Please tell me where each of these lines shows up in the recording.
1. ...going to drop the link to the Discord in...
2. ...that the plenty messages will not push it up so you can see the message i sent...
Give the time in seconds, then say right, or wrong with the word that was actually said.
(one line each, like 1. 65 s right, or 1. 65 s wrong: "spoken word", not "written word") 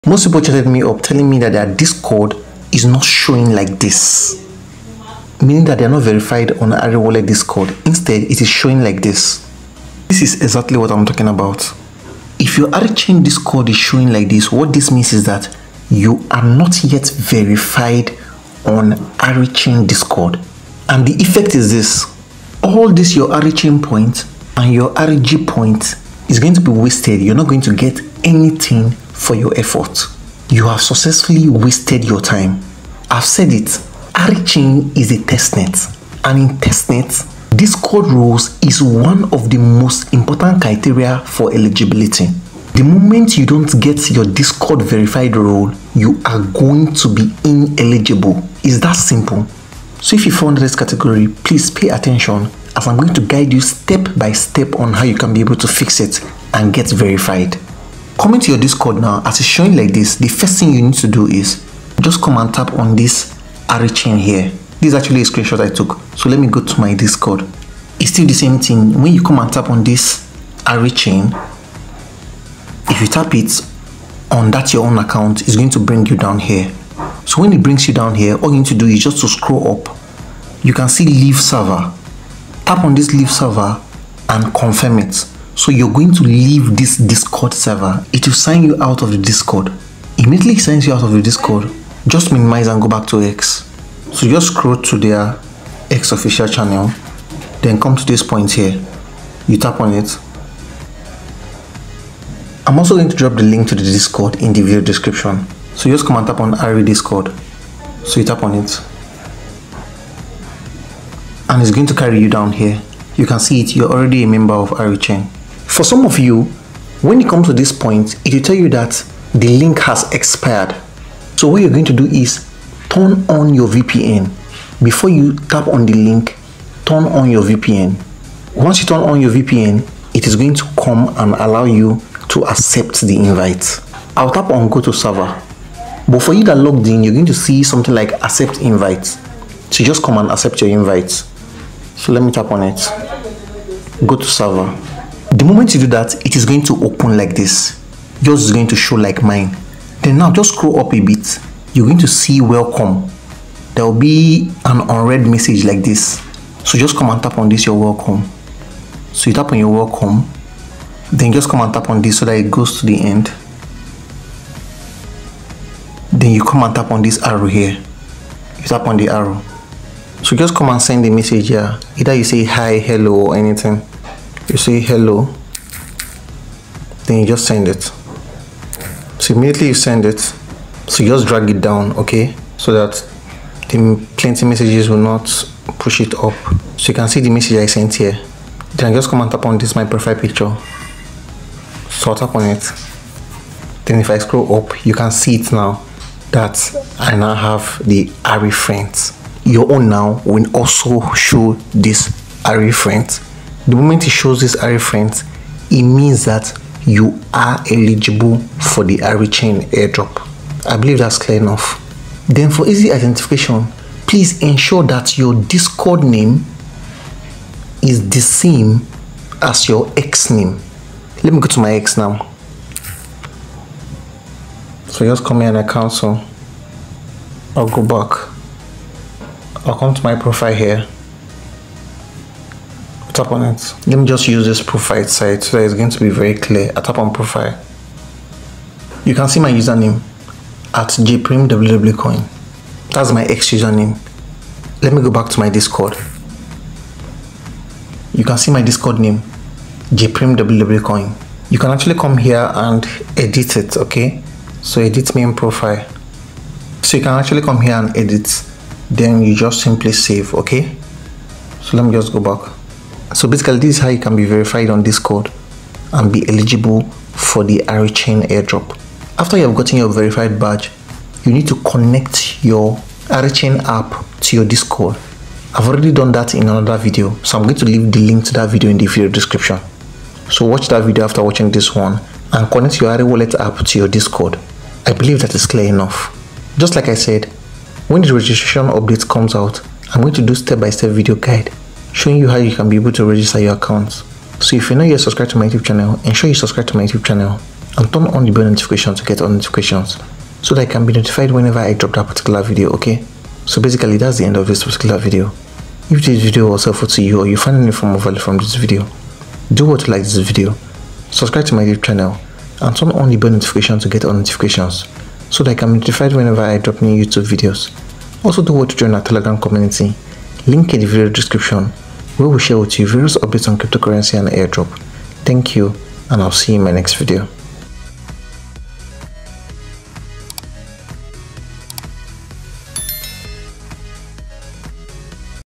1. 102 s right
2. 182 s right.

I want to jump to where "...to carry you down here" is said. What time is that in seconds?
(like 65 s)
111 s.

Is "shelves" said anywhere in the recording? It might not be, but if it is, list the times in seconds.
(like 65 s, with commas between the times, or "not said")
not said.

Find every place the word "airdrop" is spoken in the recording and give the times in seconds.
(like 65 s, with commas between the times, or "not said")
209 s, 268 s, 324 s.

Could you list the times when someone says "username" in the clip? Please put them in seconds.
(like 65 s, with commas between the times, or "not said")
239 s, 243 s.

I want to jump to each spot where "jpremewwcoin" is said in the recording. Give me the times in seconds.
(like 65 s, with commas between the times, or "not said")
240 s, 249 s.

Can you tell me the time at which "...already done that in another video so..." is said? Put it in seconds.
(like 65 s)
275 s.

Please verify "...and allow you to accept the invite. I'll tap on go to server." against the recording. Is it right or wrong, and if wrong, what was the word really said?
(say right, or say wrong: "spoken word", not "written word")
right.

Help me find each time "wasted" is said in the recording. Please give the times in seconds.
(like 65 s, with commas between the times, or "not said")
26 s, 31 s.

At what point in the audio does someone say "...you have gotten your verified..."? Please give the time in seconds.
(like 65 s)
269 s.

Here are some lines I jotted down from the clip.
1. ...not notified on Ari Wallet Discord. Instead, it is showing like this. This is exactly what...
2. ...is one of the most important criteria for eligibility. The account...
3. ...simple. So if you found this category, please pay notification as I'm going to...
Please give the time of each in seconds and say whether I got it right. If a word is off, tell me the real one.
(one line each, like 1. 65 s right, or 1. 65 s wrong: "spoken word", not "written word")
1. 5 s wrong: "verified", not "notified"
2. 38 s wrong: "moment", not "account"
3. 48 s wrong: "attention", not "notification".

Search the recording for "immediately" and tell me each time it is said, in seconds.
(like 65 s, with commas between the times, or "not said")
90 s, 179 s.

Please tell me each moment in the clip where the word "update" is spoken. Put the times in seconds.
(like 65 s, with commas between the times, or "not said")
288 s, 323 s.